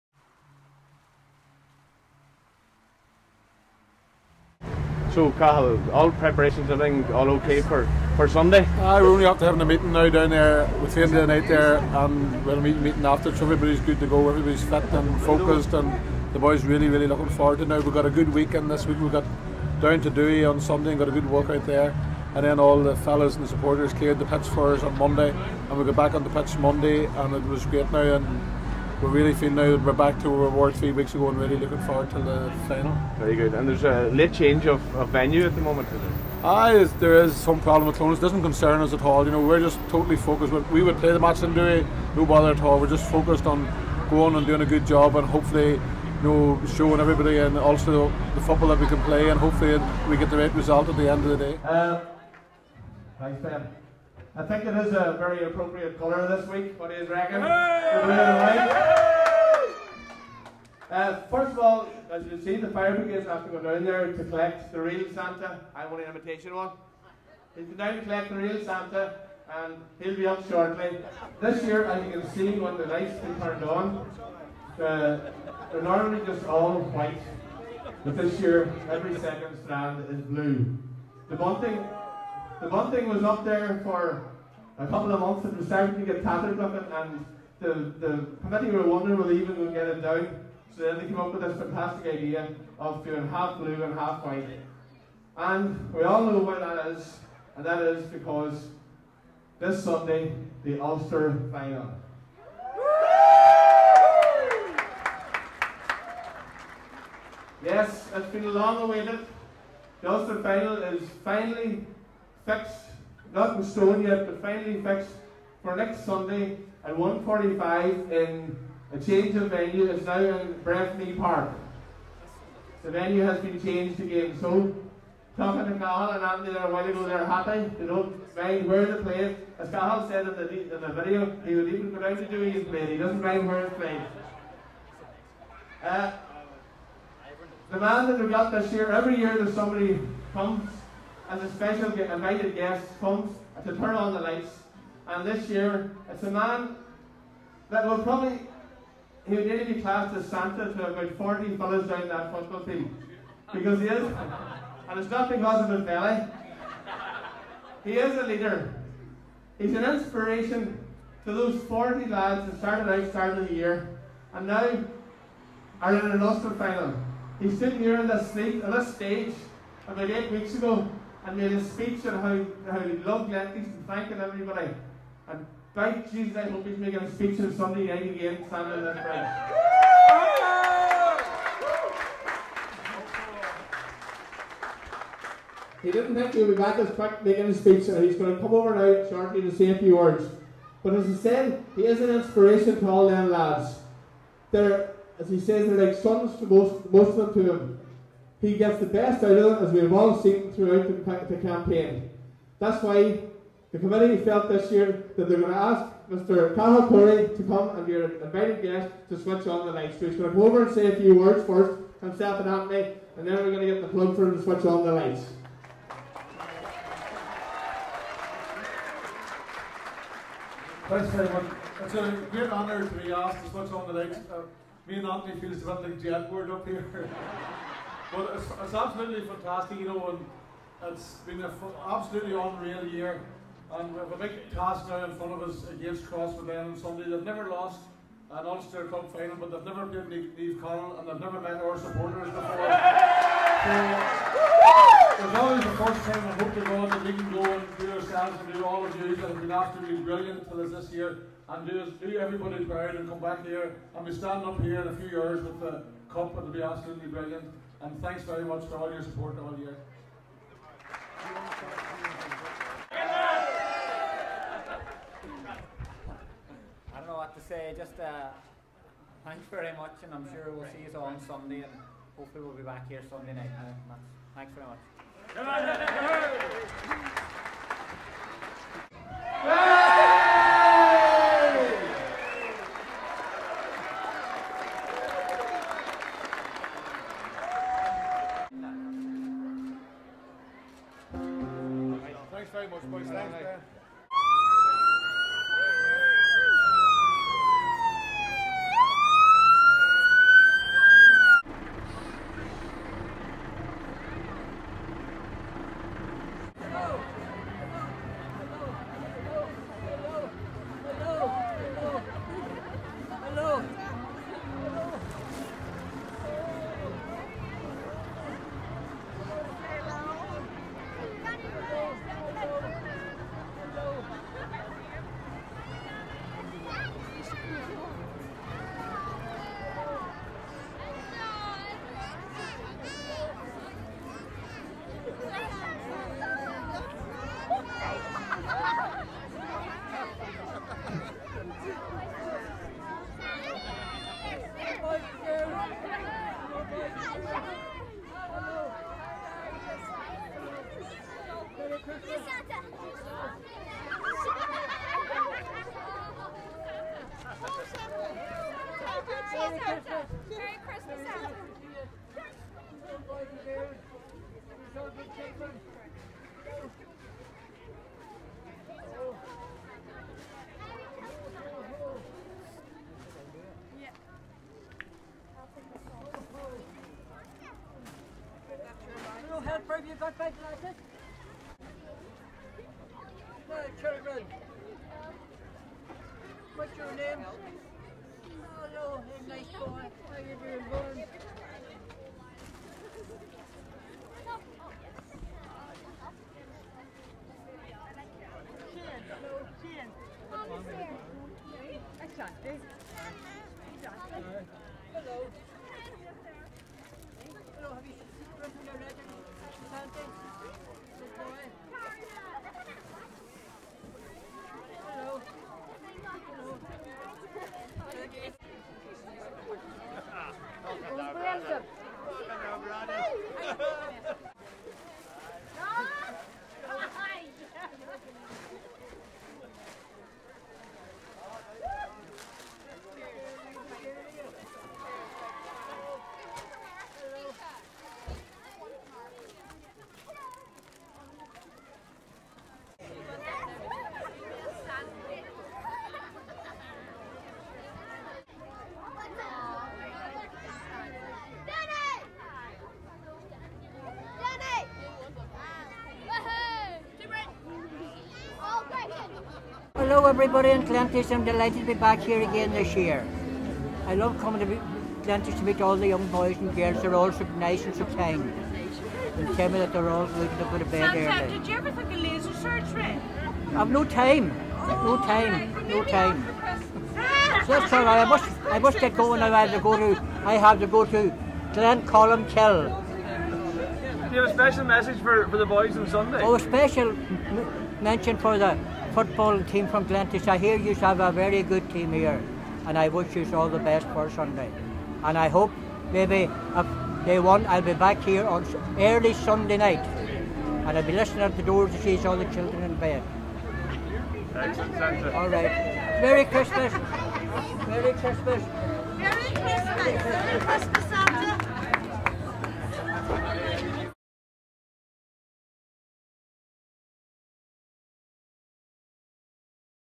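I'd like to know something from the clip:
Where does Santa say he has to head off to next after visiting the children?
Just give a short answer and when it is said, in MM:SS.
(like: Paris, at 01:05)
Glencolumbkille, at 08:01.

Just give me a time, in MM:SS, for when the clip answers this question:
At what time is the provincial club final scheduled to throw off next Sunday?
01:56.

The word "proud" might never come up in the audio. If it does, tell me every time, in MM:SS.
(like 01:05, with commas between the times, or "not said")
04:12.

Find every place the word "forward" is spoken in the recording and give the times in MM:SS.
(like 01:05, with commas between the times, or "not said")
00:17, 00:31.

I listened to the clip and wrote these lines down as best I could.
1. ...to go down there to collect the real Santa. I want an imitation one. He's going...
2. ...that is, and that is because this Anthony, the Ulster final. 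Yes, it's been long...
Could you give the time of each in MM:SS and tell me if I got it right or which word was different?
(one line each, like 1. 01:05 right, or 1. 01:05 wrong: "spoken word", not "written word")
1. 01:03 right
2. 01:36 wrong: "Sunday", not "Anthony".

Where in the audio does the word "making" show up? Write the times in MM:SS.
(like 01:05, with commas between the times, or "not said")
02:56, 03:07.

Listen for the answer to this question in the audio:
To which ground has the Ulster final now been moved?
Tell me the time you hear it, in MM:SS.
02:00.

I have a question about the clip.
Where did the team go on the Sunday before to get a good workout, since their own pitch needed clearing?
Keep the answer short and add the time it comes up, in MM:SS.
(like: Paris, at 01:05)
Dewey, at 00:20.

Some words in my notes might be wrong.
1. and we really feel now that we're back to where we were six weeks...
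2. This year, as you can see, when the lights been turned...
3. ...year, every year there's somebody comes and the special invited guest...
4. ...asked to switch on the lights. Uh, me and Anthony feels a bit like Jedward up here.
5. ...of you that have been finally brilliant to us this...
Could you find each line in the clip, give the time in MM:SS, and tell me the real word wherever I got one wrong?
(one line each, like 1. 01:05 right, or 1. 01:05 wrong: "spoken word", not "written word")
1. 00:28 wrong: "three", not "six"
2. 01:11 right
3. 02:18 right
4. 03:43 right
5. 04:08 wrong: "absolutely", not "finally".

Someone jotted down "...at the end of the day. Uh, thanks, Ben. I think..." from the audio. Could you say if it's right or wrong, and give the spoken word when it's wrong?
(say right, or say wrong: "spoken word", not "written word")
right.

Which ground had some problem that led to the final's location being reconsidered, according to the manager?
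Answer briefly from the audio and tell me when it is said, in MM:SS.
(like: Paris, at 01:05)
Clones, at 00:37.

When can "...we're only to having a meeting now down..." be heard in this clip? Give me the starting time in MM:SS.
00:09.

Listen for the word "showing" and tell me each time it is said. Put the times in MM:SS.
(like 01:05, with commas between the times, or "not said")
00:46.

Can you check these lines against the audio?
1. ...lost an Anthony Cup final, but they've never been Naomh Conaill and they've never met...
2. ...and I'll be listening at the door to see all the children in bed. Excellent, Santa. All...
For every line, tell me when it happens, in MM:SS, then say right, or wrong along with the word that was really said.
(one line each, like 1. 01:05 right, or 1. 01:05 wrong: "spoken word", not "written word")
1. 03:57 wrong: "Ulster", not "Anthony"
2. 08:20 right.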